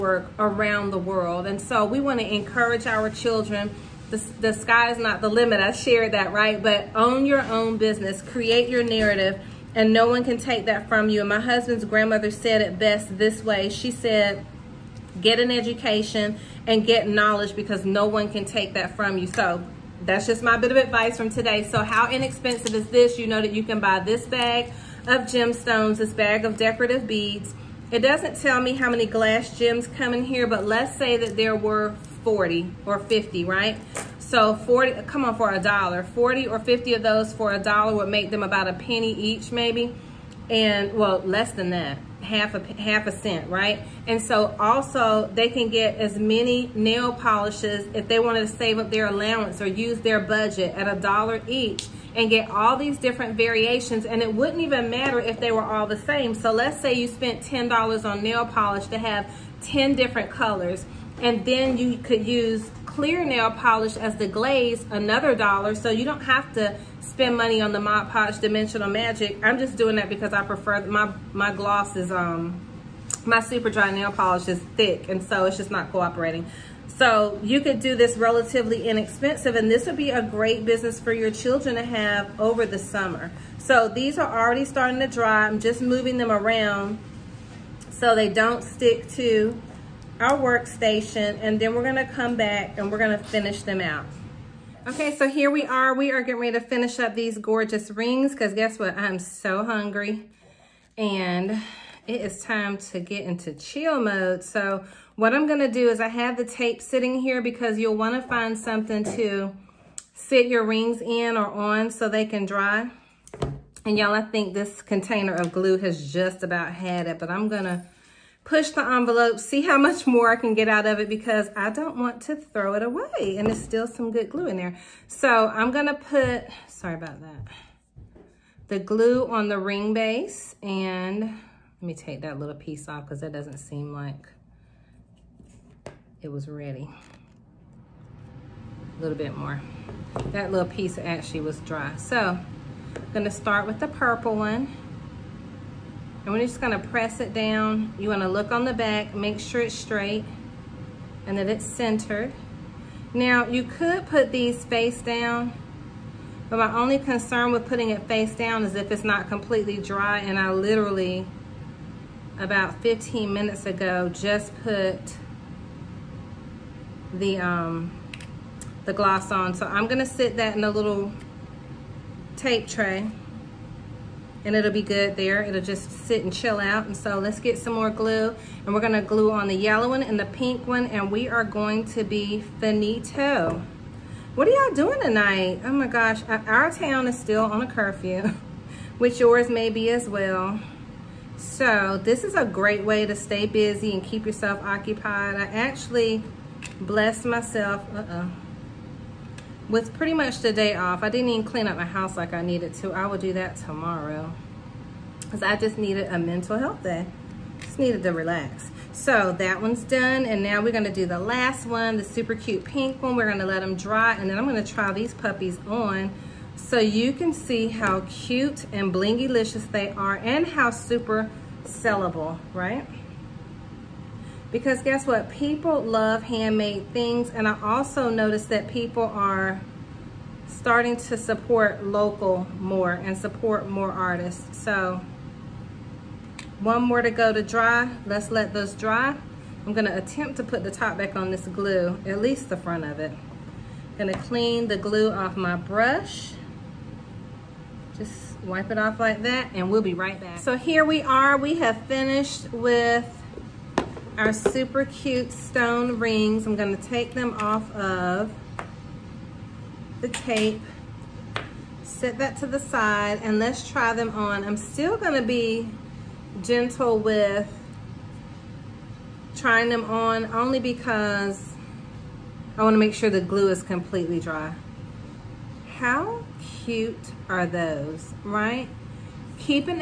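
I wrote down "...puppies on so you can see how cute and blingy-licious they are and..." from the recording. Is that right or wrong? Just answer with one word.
right.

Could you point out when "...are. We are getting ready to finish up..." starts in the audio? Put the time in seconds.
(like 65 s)
95 s.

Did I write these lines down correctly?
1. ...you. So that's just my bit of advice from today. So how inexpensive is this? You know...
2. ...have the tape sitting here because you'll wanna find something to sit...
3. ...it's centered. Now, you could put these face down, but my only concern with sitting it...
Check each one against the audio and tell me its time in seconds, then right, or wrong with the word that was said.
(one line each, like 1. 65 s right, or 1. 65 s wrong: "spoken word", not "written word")
1. 19 s right
2. 106 s right
3. 151 s wrong: "putting", not "sitting".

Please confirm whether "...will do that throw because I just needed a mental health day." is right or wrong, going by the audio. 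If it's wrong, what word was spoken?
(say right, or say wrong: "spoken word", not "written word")
wrong: "tomorrow", not "throw".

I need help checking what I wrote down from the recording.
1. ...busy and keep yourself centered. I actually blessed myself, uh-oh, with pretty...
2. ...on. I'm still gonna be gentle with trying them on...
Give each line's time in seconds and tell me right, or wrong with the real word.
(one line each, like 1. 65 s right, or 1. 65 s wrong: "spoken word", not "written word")
1. 193 s wrong: "occupied", not "centered"
2. 264 s right.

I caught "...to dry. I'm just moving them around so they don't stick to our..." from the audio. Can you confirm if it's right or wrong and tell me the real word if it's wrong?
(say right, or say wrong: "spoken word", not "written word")
right.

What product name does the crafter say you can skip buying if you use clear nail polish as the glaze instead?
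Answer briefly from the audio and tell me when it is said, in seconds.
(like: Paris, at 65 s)
Mod Podge Dimensional Magic, at 67 s.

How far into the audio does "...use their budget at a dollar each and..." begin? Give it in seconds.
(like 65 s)
49 s.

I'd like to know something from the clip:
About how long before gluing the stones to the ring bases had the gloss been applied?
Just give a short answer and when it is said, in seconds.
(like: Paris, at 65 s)
15 minutes, at 162 s.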